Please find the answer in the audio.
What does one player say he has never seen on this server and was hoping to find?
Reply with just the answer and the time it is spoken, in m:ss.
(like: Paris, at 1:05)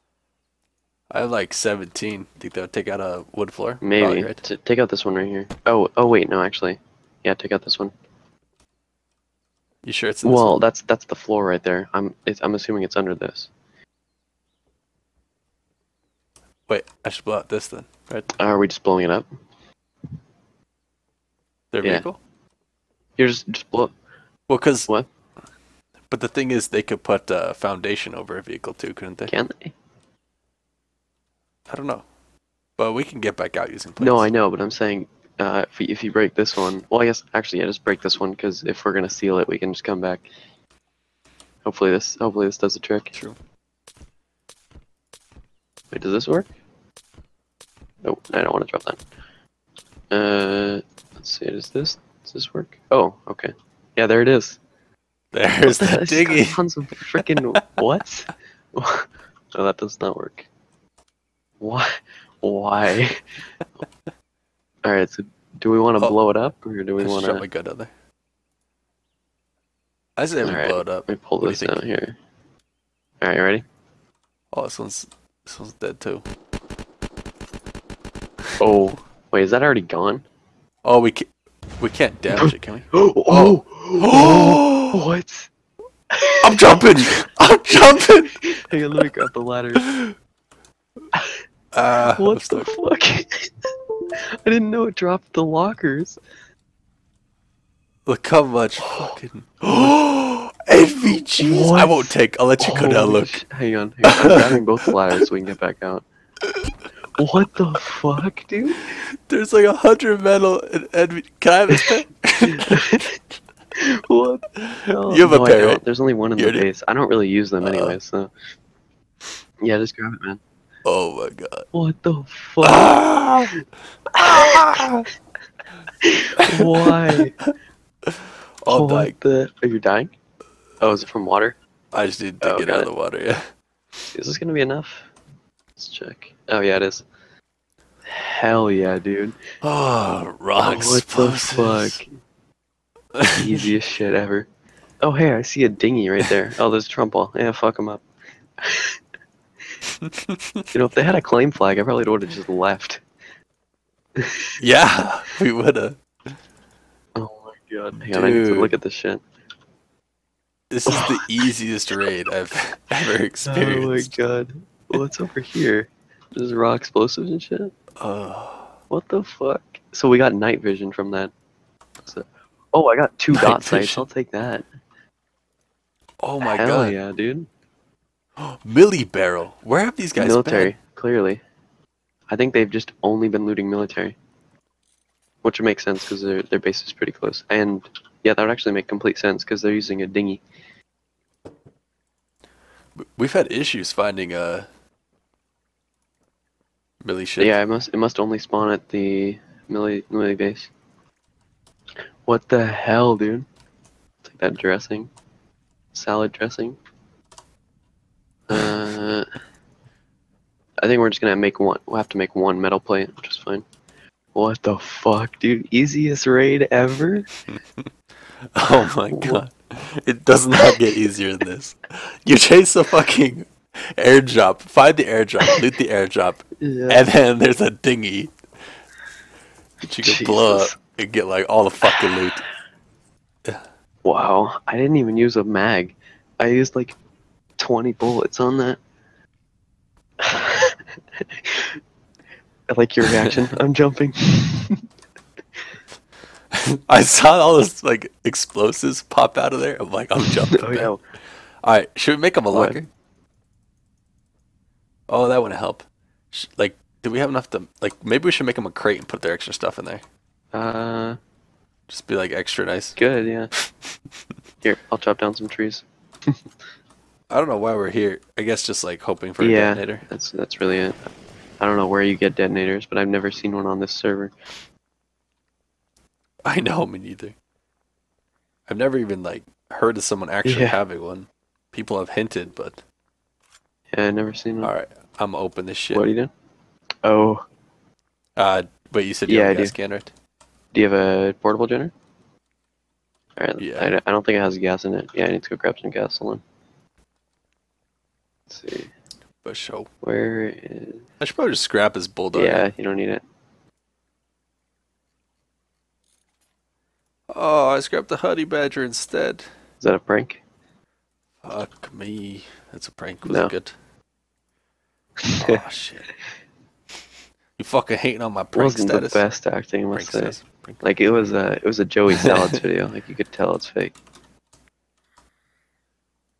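a detonator, at 4:29.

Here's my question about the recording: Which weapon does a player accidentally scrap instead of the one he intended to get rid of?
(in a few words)
honey badger.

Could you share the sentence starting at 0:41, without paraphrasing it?
Hopefully this, hopefully this does the trick.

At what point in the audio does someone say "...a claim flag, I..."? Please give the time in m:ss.
2:31.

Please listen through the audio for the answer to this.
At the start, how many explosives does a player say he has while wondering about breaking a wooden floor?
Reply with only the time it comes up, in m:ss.
0:01.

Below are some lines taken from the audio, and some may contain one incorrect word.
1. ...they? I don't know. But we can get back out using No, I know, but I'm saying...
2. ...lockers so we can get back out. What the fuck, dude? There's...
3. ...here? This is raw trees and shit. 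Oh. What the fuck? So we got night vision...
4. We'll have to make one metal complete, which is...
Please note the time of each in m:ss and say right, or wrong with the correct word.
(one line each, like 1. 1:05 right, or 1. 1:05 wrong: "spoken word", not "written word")
1. 0:29 right
2. 1:44 wrong: "ladders", not "lockers"
3. 2:45 wrong: "explosives", not "trees"
4. 3:31 wrong: "plate", not "complete".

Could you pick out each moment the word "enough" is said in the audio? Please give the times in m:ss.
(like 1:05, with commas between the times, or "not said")
2:14, 4:17.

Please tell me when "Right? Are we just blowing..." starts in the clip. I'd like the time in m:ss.
0:18.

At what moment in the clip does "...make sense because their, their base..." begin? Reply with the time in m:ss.
3:05.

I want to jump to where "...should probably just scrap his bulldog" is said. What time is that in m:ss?
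5:01.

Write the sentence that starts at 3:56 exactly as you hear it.
I used like 20 bullets on that.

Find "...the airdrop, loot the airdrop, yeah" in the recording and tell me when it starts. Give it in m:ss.
3:44.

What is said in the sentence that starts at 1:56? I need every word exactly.
I don't really use them uh, anyway, so.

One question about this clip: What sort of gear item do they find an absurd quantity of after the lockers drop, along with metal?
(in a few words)
NVGs.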